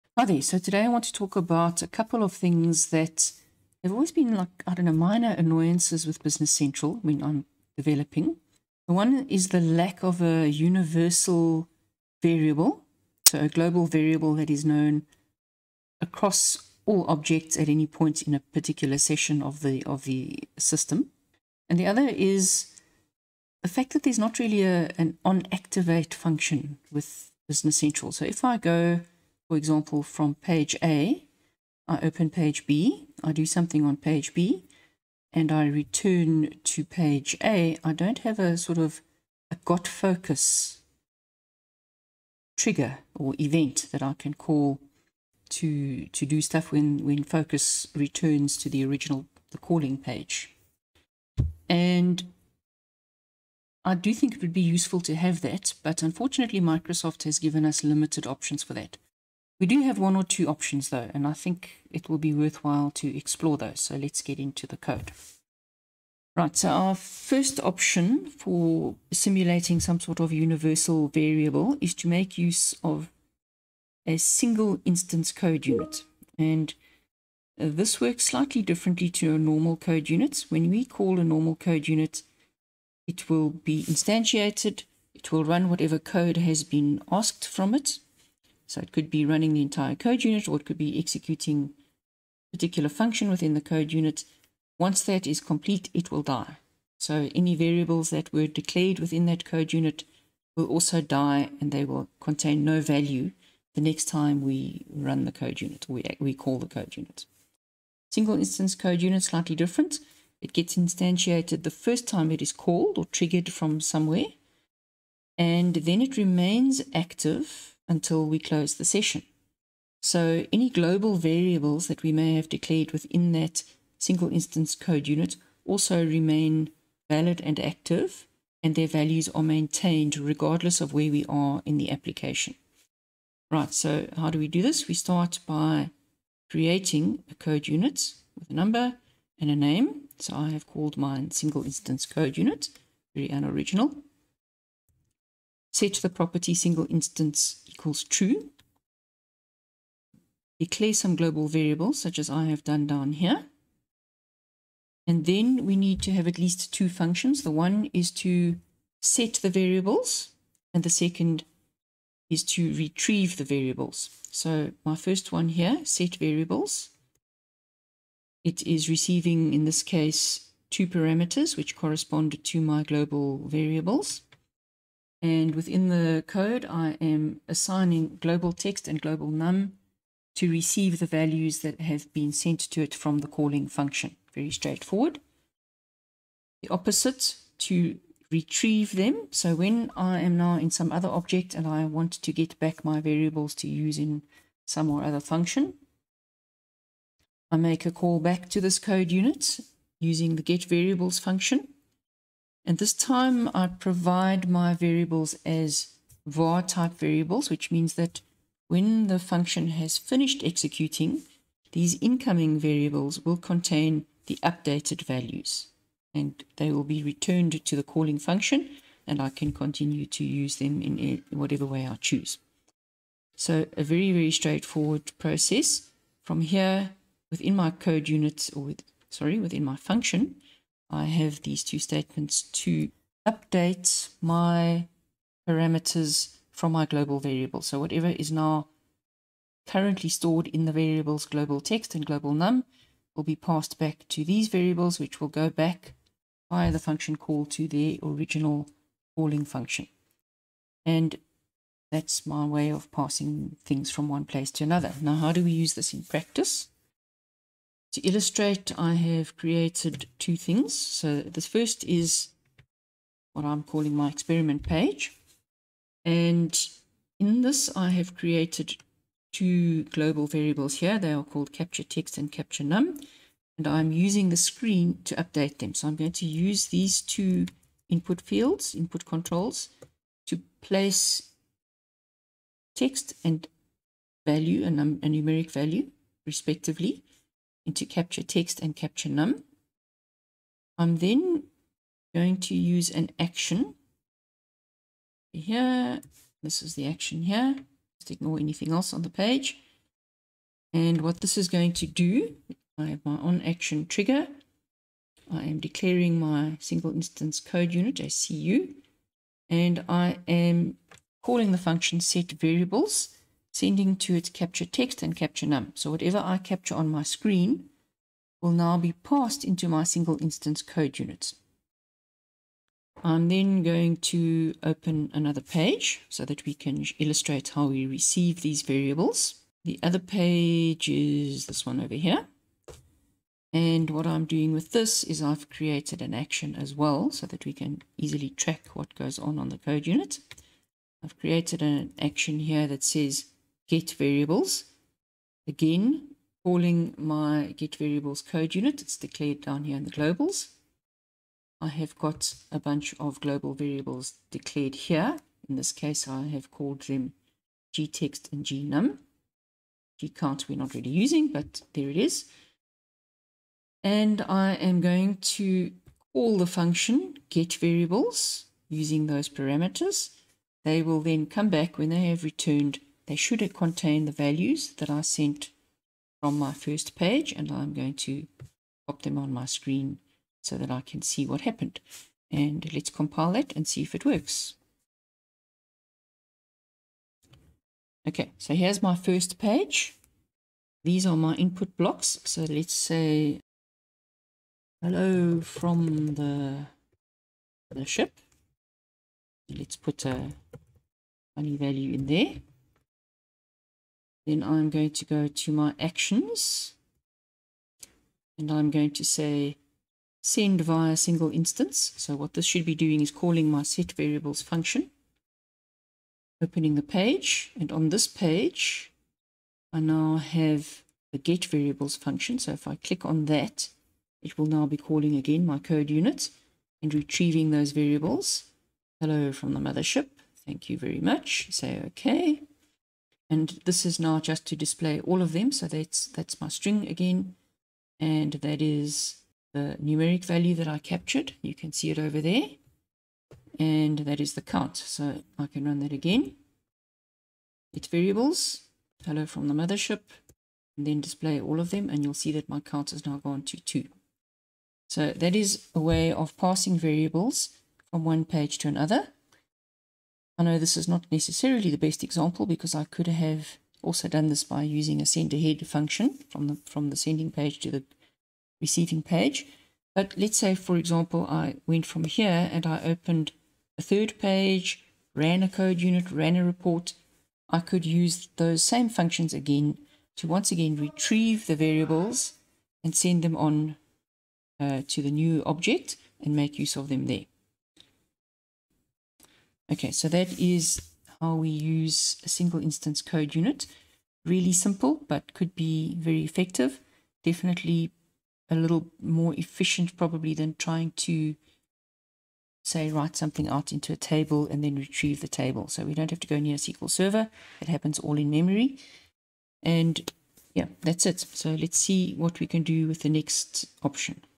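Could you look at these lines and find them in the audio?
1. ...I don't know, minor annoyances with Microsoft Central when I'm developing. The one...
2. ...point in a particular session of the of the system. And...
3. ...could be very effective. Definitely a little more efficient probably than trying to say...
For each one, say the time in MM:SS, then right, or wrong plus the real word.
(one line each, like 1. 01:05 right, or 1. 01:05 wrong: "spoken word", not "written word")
1. 00:04 wrong: "Business", not "Microsoft"
2. 00:17 right
3. 08:15 right.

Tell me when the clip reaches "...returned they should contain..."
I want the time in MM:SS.
06:12.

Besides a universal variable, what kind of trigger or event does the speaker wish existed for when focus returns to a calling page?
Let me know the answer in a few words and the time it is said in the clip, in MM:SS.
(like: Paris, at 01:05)
got focus, at 00:39.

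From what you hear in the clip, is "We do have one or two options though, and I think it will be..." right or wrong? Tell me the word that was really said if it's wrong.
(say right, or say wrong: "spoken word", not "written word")
right.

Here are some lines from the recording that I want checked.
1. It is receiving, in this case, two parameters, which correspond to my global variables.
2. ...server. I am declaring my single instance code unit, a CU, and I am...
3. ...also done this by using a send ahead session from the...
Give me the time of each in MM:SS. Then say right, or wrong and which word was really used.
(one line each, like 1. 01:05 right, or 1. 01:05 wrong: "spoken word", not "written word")
1. 02:48 right
2. 05:03 wrong: "trigger", not "server"
3. 07:43 wrong: "function", not "session".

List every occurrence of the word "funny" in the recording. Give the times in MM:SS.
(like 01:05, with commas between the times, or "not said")
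06:41.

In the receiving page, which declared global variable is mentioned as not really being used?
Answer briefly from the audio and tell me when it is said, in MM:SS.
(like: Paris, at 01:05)
gcount, at 06:00.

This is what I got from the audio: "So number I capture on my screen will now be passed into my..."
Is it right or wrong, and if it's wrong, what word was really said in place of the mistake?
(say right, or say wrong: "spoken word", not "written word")
wrong: "whatever", not "number".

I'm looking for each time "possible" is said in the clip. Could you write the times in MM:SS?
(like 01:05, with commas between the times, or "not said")
not said.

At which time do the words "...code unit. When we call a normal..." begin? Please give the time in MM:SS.
01:19.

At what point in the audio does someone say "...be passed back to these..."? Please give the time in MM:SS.
04:03.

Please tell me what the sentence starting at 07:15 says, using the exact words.
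So that's, that's my string again.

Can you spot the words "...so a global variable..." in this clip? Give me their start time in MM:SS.
00:13.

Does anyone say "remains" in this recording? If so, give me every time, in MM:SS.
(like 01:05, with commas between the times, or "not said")
01:56, 02:06.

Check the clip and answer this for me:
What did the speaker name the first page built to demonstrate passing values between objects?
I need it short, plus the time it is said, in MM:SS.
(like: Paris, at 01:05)
experiment page, at 04:24.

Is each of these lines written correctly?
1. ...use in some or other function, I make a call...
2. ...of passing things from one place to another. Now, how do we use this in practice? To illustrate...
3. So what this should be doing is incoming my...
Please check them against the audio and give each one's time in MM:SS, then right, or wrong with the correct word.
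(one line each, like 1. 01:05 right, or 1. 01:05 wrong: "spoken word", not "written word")
1. 03:13 right
2. 04:12 right
3. 06:51 wrong: "calling", not "incoming".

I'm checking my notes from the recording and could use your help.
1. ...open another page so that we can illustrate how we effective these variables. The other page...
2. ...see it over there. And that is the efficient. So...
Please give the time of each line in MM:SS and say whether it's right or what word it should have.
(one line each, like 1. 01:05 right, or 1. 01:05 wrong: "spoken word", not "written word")
1. 05:24 wrong: "receive", not "effective"
2. 07:21 wrong: "count", not "efficient".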